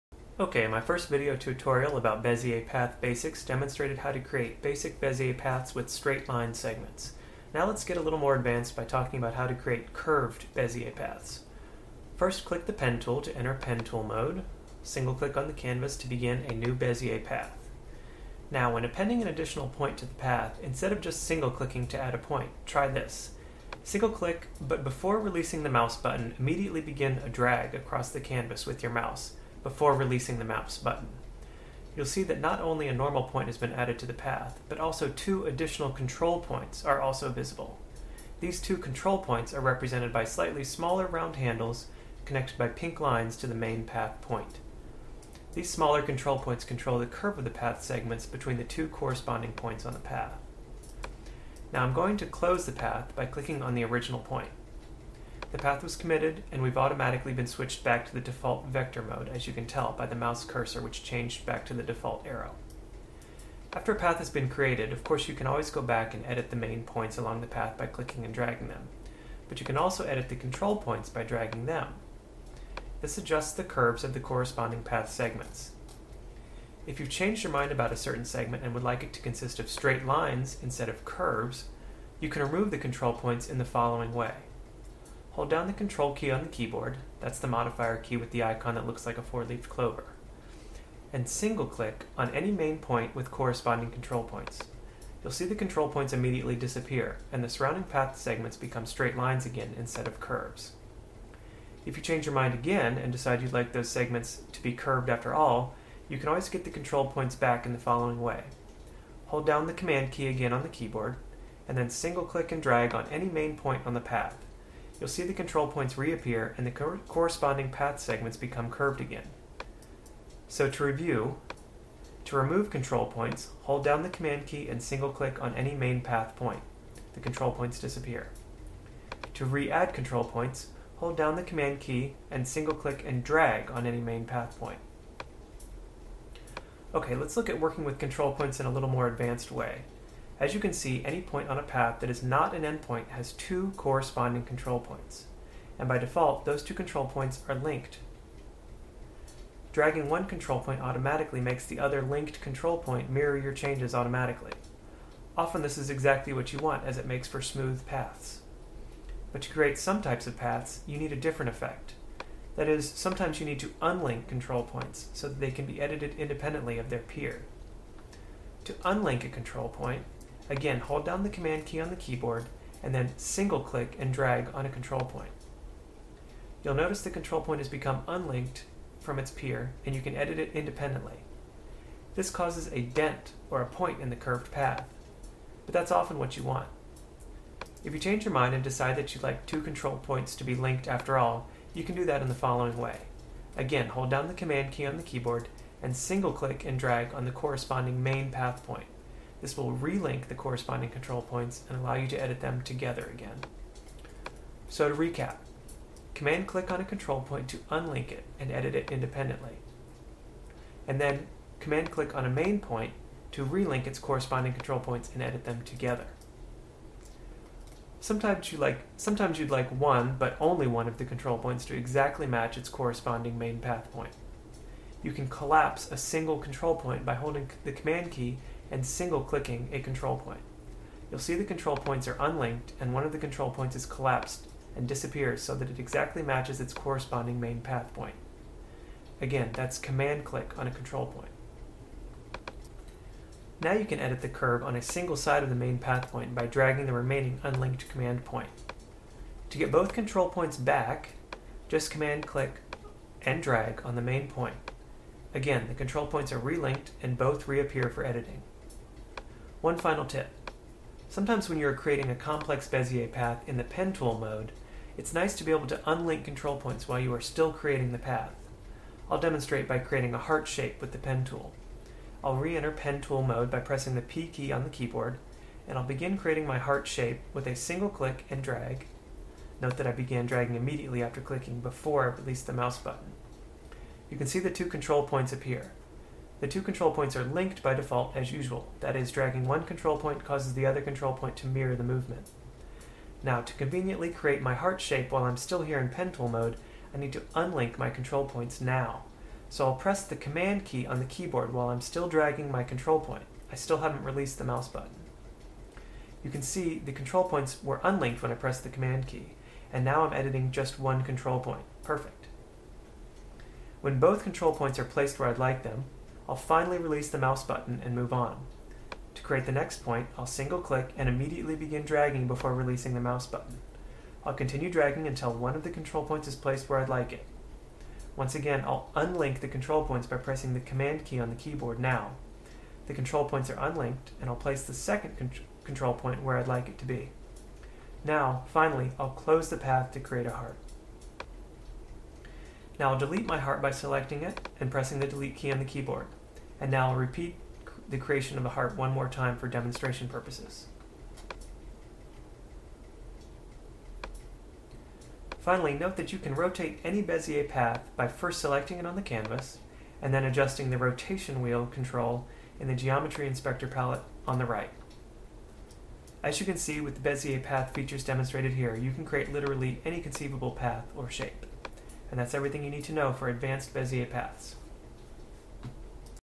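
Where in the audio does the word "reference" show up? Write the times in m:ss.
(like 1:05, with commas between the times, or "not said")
not said.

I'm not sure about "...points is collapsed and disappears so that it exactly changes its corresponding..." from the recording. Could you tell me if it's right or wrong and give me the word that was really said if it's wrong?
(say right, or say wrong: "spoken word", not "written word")
wrong: "matches", not "changes".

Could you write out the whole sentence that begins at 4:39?
Note that I began dragging immediately after clicking before I released the mouse button.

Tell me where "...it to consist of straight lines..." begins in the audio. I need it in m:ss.
1:19.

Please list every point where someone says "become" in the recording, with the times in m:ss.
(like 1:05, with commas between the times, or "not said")
1:38, 1:58, 2:57.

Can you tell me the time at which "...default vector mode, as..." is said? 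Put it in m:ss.
0:58.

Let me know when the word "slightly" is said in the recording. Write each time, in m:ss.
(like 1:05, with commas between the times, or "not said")
0:40.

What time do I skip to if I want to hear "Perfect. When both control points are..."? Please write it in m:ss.
5:11.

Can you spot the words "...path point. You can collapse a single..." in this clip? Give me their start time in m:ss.
3:43.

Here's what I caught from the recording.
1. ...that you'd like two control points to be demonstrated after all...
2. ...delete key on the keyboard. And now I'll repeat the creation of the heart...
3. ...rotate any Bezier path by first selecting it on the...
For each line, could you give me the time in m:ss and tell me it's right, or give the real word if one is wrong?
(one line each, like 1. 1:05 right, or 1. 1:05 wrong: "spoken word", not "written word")
1. 3:08 wrong: "linked", not "demonstrated"
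2. 5:45 right
3. 5:56 right.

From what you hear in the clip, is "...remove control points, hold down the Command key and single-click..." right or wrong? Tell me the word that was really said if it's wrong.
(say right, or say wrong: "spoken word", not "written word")
right.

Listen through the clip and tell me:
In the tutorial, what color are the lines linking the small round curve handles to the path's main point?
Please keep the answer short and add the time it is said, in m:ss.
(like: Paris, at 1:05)
Pink, at 0:42.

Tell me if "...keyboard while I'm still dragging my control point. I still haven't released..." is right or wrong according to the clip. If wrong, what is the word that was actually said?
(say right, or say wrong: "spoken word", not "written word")
right.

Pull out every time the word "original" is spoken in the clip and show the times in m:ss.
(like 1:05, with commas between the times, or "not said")
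0:53.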